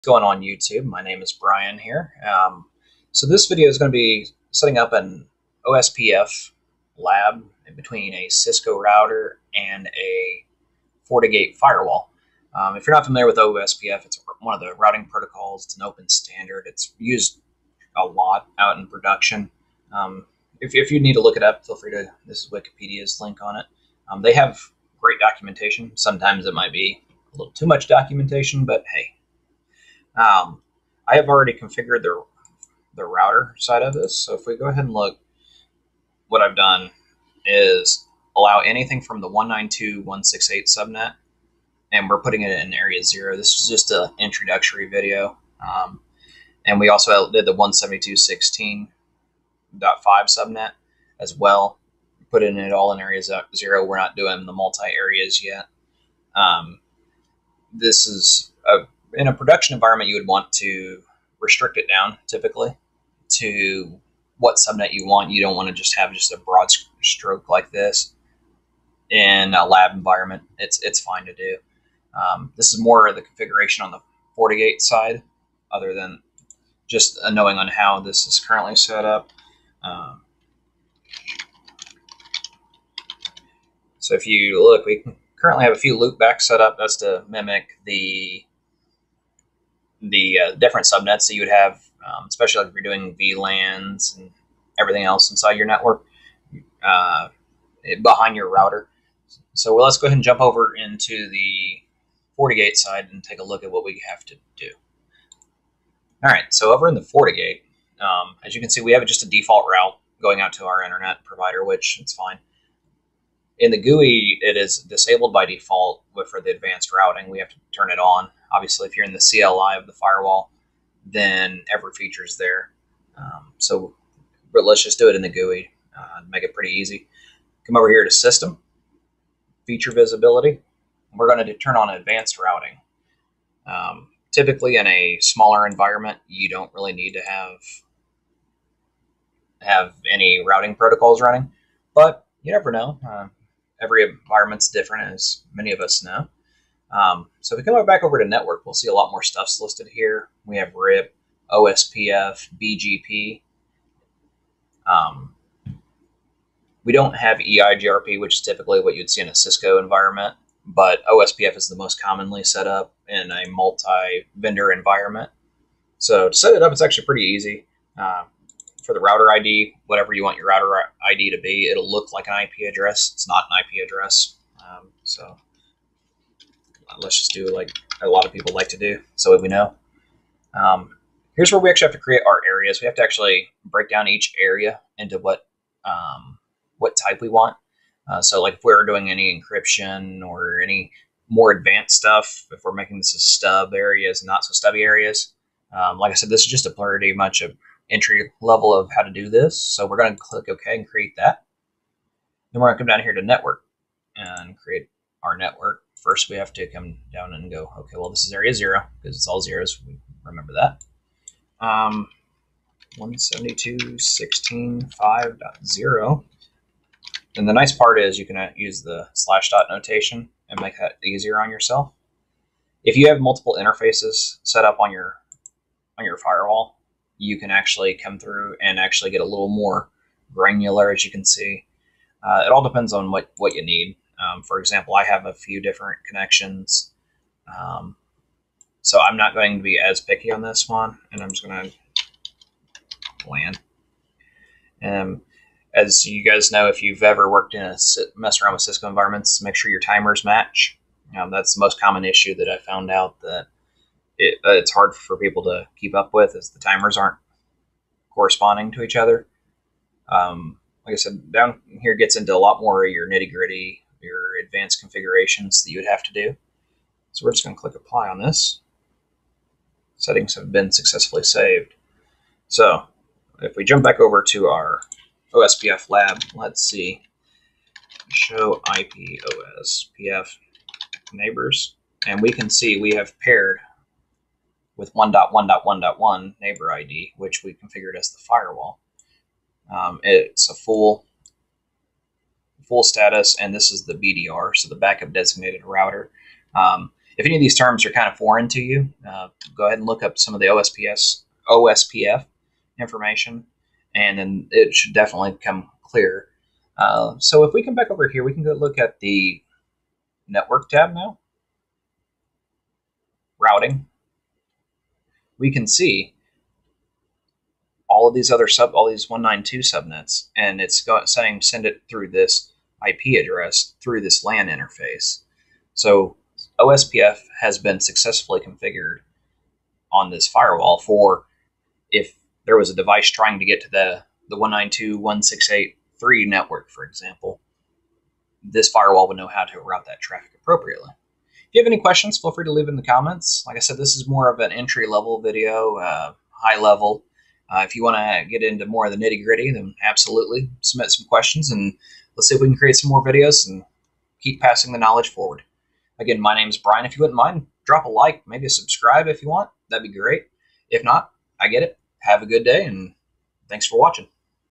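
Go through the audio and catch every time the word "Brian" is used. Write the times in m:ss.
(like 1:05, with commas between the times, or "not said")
0:01, 5:56.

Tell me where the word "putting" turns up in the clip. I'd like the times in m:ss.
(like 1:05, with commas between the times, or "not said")
0:42, 0:52.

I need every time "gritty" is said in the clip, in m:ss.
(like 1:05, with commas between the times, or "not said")
4:23, 5:49.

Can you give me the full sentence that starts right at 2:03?
Um, so, but let's just do it in the GUI, uh, make it pretty easy.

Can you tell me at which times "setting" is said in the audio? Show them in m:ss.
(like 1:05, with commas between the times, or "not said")
0:04, 4:29.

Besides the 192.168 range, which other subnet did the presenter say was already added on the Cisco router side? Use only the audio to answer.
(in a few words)
172.16.5.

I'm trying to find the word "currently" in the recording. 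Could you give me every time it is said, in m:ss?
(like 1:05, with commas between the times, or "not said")
1:18, 1:25.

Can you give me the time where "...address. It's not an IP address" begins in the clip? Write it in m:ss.
2:52.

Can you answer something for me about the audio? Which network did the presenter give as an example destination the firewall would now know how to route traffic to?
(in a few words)
192.168.3.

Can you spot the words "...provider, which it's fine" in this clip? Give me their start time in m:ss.
1:51.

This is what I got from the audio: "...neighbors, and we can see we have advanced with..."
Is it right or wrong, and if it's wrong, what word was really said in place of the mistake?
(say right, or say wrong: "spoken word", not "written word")
wrong: "paired", not "advanced".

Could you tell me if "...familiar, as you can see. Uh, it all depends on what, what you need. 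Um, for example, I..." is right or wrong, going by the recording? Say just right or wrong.
wrong.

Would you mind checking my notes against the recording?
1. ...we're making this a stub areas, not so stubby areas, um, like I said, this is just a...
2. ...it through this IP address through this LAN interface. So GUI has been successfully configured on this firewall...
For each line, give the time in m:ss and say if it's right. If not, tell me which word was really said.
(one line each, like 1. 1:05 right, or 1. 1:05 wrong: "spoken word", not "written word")
1. 3:12 right
2. 5:21 wrong: "OSPF", not "GUI".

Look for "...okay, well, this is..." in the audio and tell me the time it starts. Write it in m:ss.
3:27.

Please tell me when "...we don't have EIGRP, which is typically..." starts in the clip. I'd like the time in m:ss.
2:36.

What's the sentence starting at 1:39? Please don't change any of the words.
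So well, let's go ahead and jump over into the FortiGate side and take a look at what we have to do.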